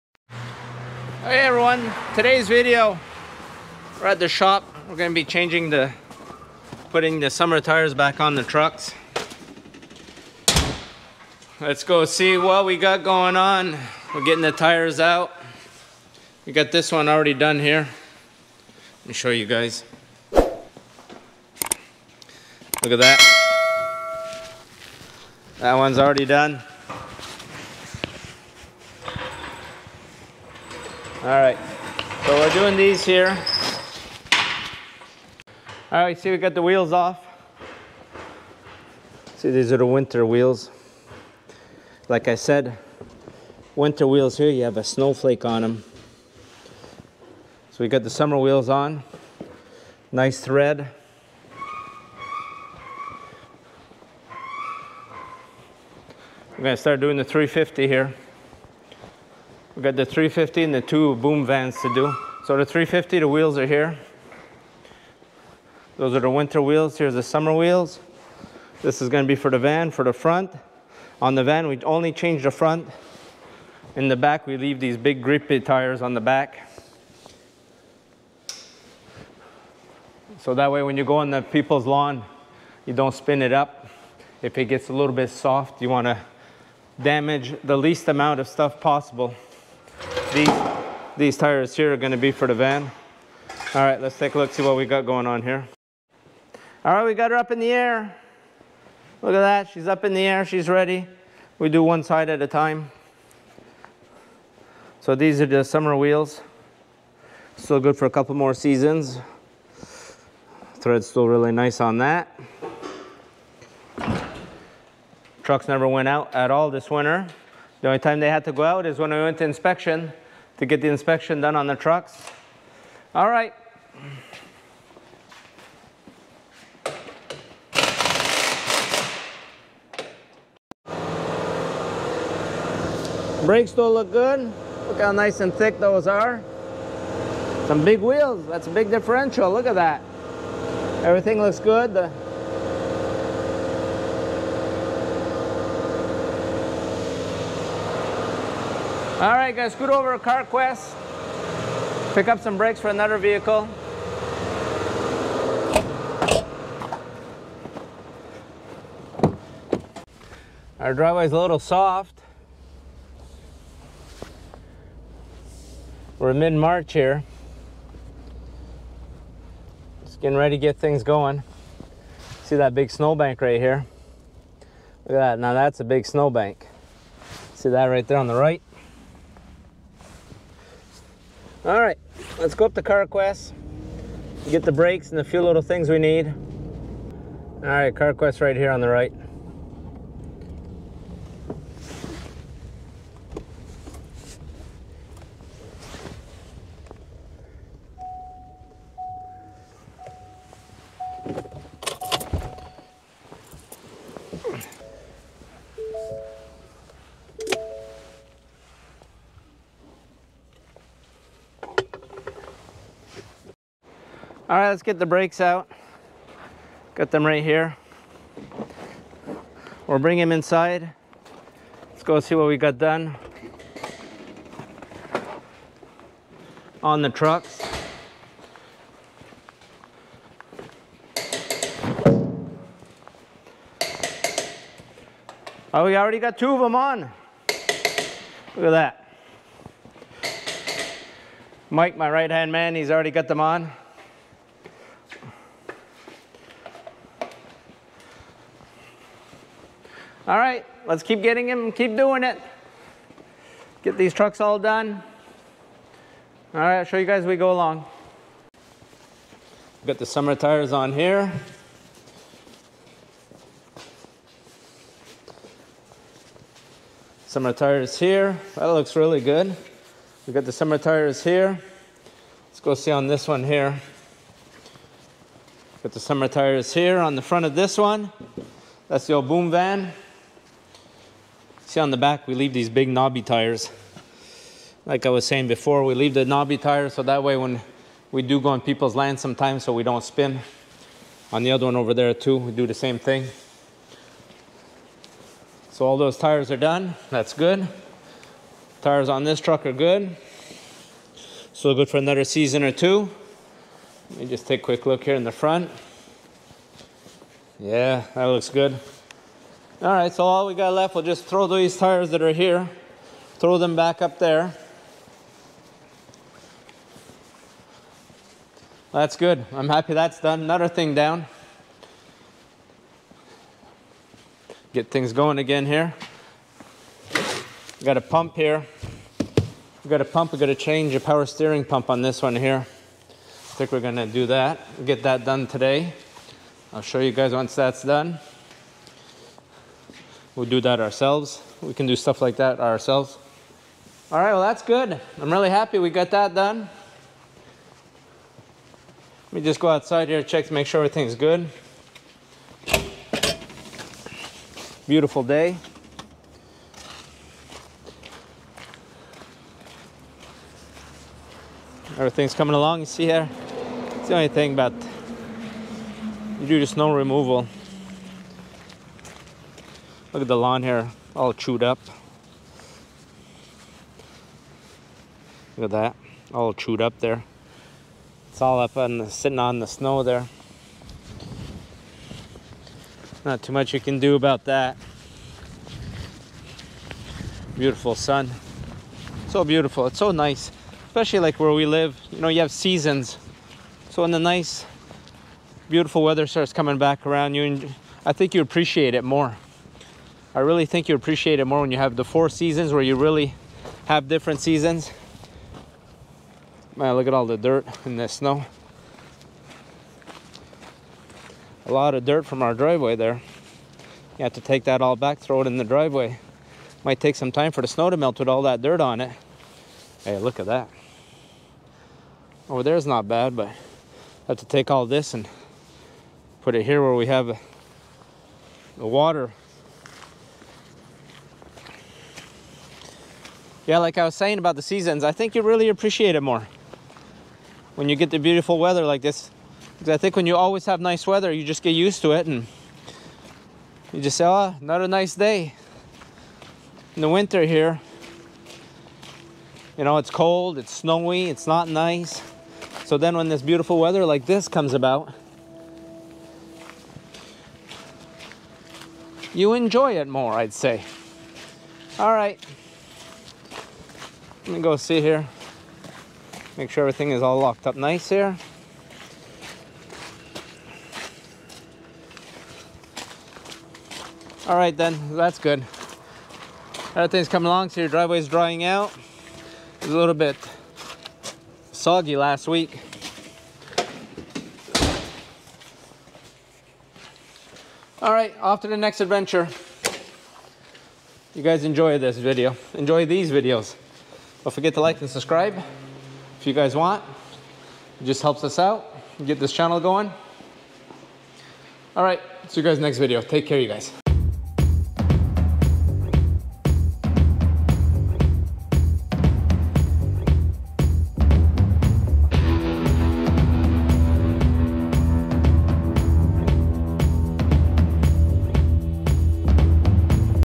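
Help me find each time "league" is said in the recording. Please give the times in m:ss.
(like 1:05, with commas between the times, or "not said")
not said.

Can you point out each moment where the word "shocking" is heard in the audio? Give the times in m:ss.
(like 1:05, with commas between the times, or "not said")
not said.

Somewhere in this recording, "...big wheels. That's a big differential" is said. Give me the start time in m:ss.
2:17.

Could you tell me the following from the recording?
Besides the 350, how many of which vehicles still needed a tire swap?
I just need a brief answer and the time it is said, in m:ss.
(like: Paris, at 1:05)
2 boom vans, at 1:00.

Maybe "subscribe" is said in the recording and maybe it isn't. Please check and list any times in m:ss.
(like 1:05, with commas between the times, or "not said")
8:15.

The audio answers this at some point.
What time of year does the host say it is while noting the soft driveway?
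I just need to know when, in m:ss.
2:46.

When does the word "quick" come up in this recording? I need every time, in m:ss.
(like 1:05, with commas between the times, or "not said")
5:04.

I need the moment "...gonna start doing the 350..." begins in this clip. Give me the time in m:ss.
0:56.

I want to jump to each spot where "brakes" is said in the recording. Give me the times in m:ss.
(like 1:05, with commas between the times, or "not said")
2:13, 2:32, 3:04, 3:35.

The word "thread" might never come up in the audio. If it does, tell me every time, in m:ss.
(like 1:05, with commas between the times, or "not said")
0:50, 1:50.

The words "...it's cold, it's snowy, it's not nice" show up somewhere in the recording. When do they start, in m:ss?
7:29.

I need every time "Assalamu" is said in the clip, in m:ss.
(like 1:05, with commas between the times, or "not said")
not said.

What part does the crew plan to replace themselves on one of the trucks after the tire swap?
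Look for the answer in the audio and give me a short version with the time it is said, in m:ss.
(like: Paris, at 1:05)
Power steering pump, at 5:30.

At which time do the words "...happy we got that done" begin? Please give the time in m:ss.
5:45.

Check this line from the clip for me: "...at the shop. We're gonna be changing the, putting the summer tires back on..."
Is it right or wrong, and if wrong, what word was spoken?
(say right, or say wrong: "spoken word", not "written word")
right.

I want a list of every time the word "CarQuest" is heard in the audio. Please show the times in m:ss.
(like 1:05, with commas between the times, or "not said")
2:30, 3:02, 3:07.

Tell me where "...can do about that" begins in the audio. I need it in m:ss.
6:23.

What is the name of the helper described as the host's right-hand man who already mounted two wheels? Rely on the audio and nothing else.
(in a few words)
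Mike.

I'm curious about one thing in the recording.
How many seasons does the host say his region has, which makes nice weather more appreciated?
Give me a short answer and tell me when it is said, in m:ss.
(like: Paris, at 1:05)
4, at 6:42.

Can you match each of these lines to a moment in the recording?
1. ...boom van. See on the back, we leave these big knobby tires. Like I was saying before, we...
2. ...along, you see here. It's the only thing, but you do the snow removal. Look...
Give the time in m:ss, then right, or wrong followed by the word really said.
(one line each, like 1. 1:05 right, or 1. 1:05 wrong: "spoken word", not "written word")
1. 4:39 right
2. 6:02 right.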